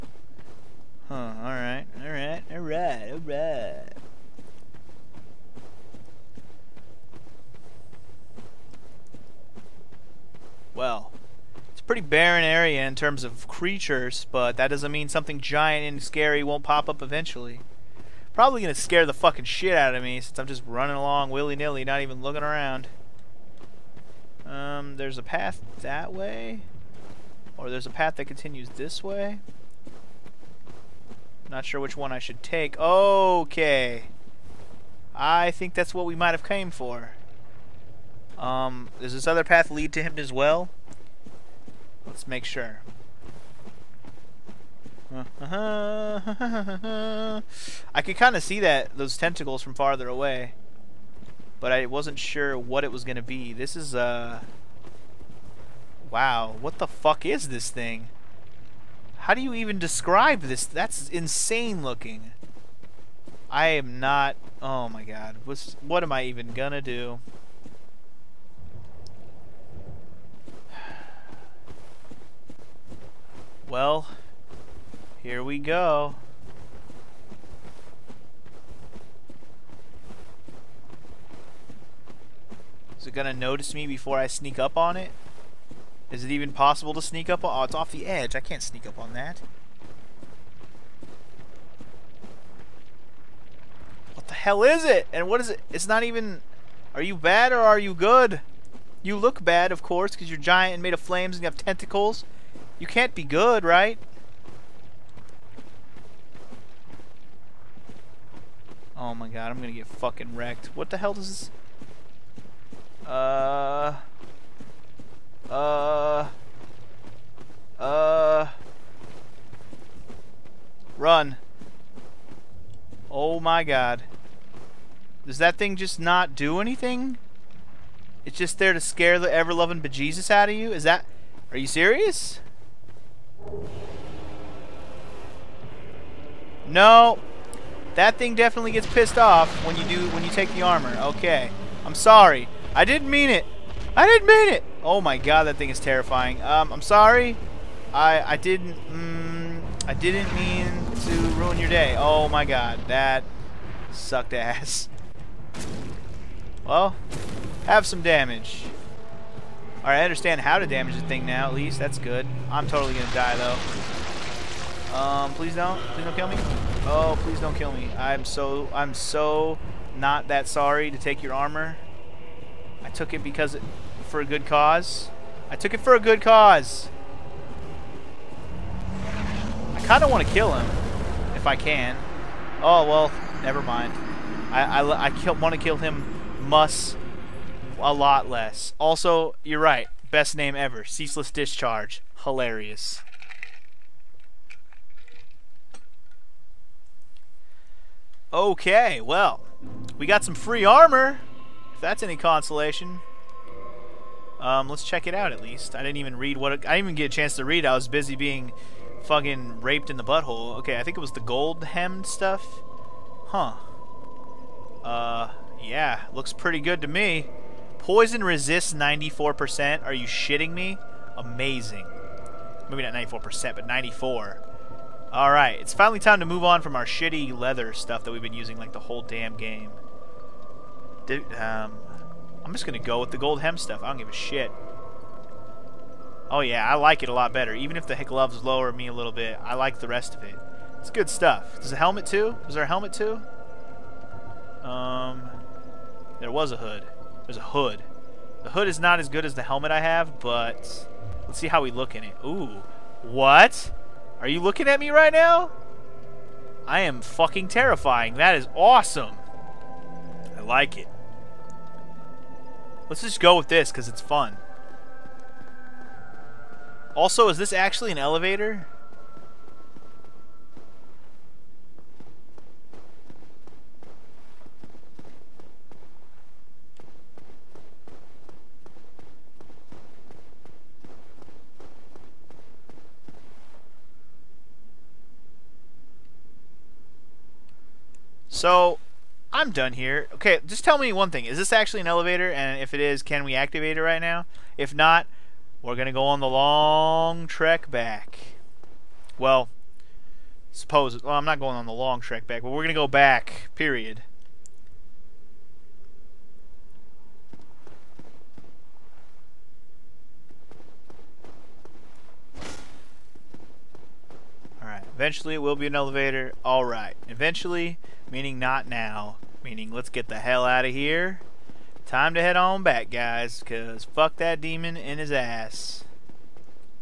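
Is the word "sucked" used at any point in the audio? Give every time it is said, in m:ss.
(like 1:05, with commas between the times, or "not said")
2:33.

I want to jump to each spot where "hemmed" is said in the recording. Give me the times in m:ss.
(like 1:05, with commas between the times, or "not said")
3:31.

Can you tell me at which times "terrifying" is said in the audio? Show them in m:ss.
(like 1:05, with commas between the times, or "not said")
2:25, 4:17.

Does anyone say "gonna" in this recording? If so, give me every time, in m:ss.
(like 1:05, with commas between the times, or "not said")
0:18, 0:53, 1:06, 1:23, 1:49, 2:42, 3:52.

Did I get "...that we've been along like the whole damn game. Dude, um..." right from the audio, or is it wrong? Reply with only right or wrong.
wrong.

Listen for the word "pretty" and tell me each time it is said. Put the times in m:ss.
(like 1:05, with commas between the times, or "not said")
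0:11, 3:36.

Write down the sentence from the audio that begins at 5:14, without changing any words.
Alright, eventually it will be an elevator.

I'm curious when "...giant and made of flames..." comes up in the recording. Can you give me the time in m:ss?
1:40.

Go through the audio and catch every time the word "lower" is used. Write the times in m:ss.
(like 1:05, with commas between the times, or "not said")
3:58.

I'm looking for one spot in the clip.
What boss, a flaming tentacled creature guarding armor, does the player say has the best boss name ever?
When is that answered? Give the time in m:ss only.
3:10.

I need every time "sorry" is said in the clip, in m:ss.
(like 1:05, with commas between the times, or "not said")
2:21, 2:26, 2:50.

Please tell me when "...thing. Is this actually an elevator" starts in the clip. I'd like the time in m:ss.
4:51.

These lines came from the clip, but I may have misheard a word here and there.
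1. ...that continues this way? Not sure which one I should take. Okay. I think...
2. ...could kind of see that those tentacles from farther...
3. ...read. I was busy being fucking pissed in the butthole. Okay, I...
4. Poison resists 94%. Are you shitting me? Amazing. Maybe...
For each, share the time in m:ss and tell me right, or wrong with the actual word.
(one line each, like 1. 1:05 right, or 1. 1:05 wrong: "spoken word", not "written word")
1. 0:28 right
2. 0:48 right
3. 3:27 wrong: "raped", not "pissed"
4. 3:37 right.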